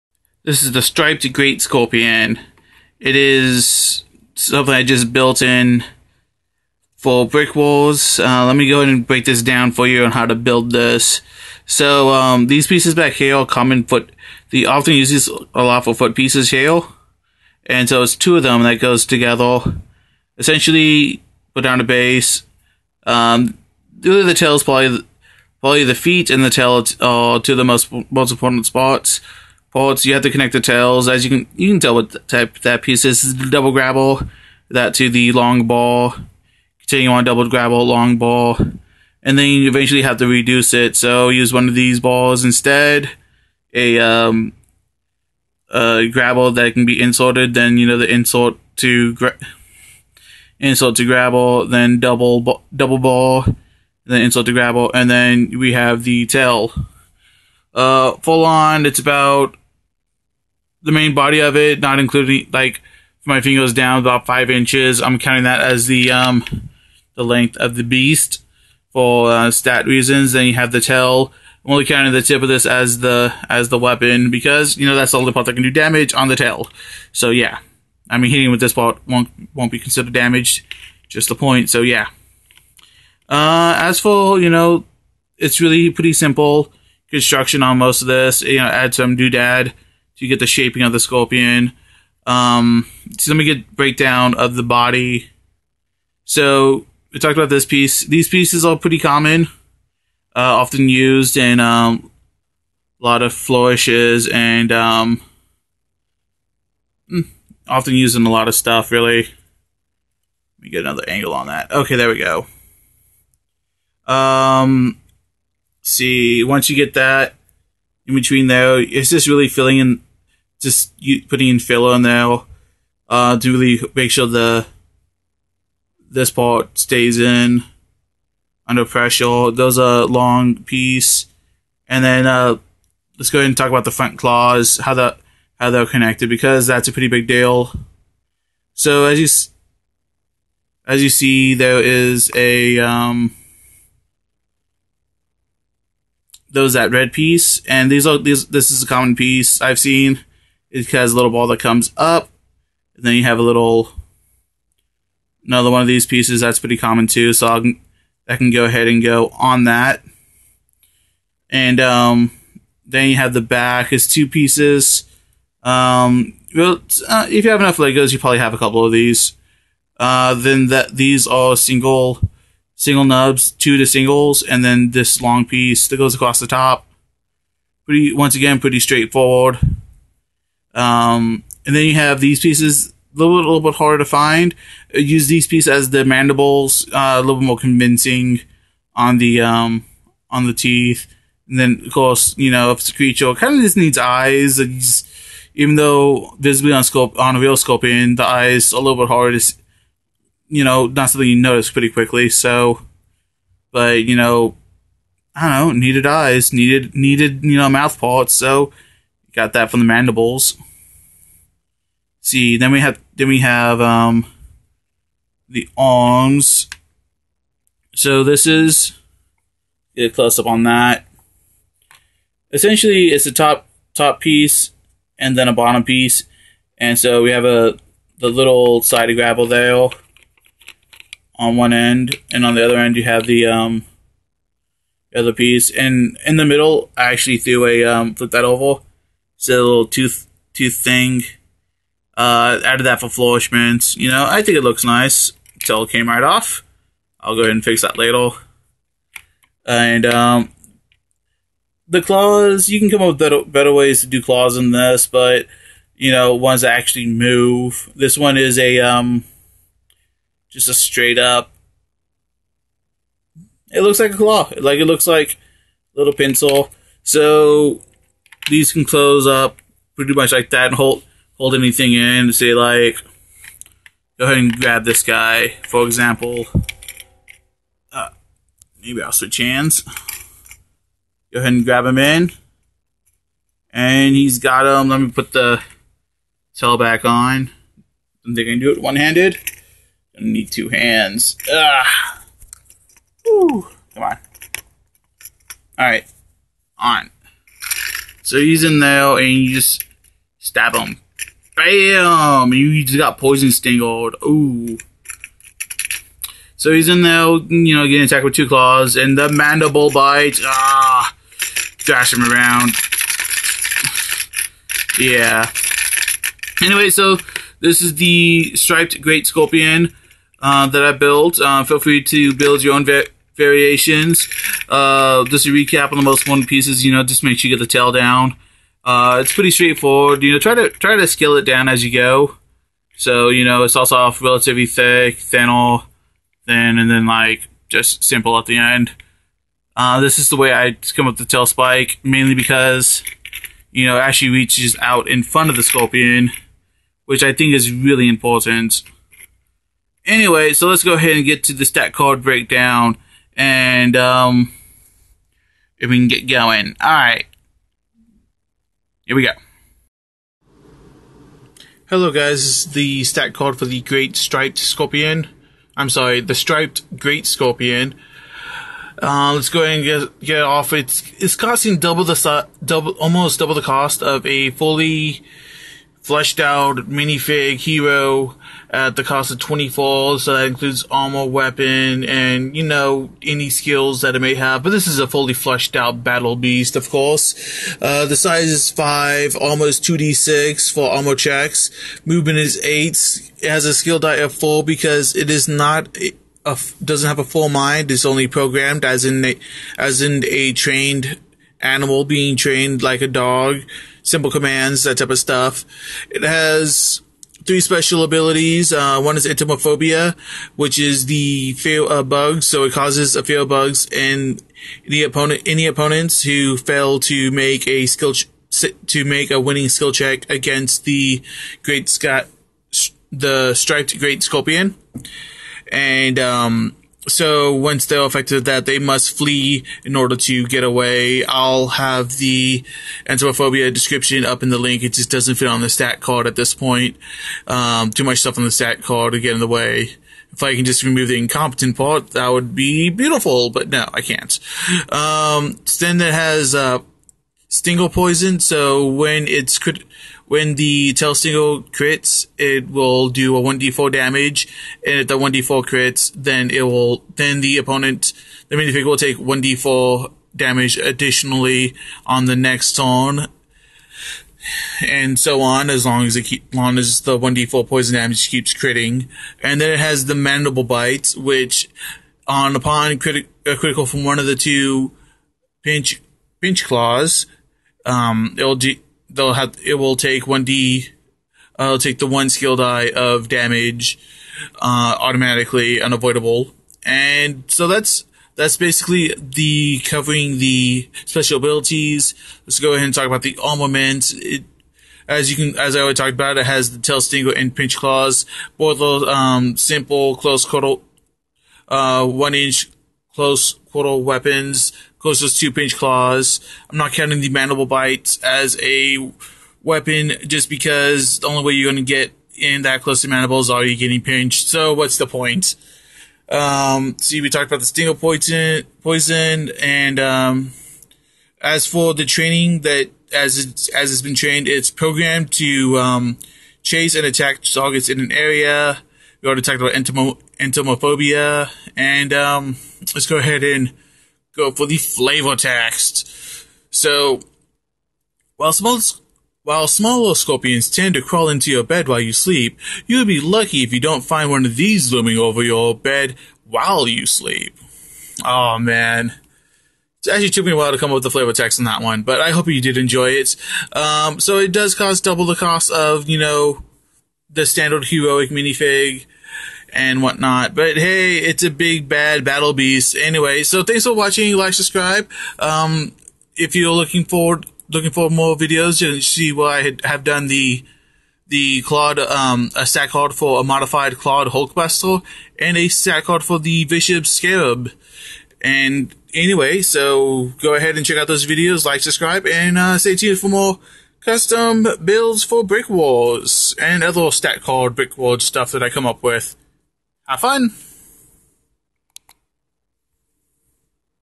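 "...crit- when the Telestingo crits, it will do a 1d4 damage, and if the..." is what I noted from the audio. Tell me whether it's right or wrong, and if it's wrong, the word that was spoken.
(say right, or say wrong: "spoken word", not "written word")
right.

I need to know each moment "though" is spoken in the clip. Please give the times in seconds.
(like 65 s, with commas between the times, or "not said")
118 s, 195 s.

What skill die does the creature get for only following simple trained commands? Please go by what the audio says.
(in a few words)
4.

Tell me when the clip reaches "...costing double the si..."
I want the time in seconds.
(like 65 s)
371 s.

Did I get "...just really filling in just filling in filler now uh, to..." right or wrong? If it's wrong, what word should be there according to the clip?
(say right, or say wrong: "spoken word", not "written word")
wrong: "putting", not "filling".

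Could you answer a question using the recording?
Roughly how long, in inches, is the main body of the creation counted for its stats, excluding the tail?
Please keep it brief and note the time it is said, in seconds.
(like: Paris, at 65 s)
5 inches, at 64 s.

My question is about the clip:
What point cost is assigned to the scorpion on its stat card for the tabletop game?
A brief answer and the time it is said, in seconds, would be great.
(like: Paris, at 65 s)
24, at 379 s.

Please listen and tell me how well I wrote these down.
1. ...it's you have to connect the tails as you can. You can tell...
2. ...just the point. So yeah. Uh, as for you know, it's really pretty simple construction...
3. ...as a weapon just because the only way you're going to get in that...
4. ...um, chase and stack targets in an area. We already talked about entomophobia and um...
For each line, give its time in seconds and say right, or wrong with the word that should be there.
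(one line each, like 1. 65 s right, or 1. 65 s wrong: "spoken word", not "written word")
1. 29 s right
2. 81 s right
3. 508 s right
4. 525 s wrong: "attack", not "stack".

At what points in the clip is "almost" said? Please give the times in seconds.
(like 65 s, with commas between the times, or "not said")
372 s, 389 s.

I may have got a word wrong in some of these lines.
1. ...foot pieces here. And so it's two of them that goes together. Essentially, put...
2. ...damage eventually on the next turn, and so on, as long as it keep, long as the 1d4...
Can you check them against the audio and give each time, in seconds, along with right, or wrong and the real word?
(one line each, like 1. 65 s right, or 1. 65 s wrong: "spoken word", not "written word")
1. 15 s right
2. 460 s wrong: "additionally", not "eventually".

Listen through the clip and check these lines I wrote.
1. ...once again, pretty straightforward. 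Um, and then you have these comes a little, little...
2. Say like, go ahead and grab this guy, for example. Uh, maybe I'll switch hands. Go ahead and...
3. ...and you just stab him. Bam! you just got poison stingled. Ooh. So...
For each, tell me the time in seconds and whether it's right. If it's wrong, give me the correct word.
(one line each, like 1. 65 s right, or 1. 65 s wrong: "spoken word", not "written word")
1. 178 s wrong: "pieces", not "comes"
2. 272 s right
3. 299 s right.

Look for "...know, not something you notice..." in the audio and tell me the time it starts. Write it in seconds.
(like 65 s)
200 s.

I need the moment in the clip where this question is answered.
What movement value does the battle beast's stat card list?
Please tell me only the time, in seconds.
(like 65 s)
392 s.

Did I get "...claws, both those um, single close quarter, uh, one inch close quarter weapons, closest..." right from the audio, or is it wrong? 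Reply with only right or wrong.
wrong.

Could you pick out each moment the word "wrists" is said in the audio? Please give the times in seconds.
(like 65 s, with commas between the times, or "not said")
not said.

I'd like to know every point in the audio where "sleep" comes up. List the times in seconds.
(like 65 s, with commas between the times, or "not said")
542 s, 547 s.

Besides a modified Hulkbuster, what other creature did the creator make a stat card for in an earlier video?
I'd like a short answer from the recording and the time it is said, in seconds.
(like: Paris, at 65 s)
Bishop Scarab, at 576 s.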